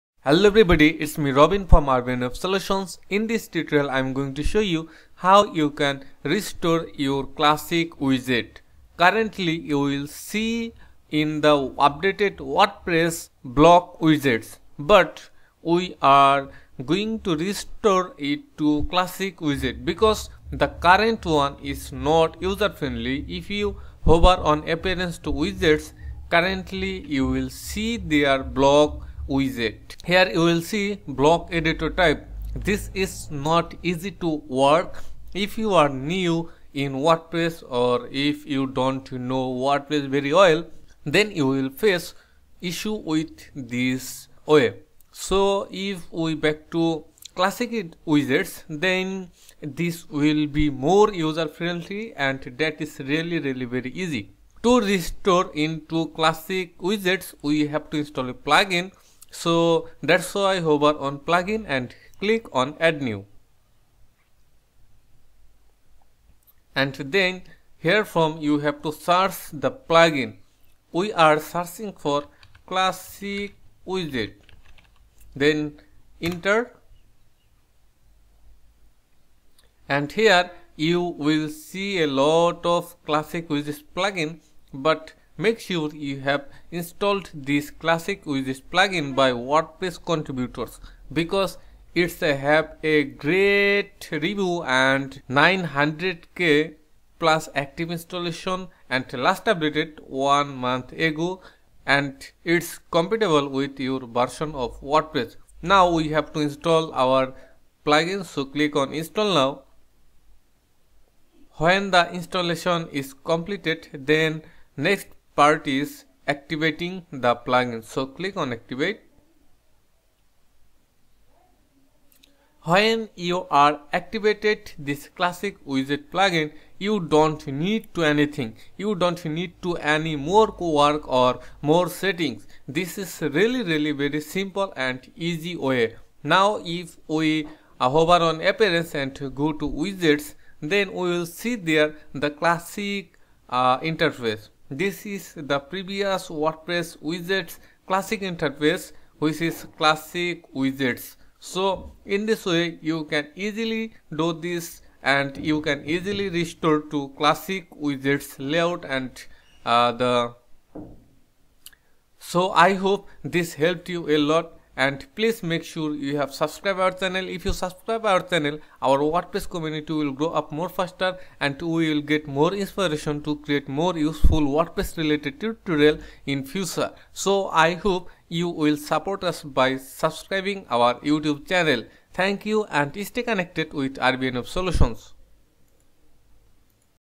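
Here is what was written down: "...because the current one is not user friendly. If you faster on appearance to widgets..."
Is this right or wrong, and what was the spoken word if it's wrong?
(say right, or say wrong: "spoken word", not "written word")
wrong: "hover", not "faster".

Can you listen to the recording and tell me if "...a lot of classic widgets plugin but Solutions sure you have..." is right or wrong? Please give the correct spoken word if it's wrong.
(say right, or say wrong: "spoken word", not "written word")
wrong: "Make", not "Solutions".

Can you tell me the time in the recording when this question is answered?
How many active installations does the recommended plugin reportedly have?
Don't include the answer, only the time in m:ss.
1:35.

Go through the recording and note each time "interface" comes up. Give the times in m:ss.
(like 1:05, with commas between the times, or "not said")
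2:23, 2:28.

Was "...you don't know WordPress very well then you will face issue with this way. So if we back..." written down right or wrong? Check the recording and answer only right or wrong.
right.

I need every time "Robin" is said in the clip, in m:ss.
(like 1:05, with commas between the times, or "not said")
0:01.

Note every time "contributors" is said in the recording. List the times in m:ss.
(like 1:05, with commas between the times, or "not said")
1:30.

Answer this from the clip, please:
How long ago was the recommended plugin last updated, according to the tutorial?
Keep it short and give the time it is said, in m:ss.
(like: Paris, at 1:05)
1 month ago, at 1:40.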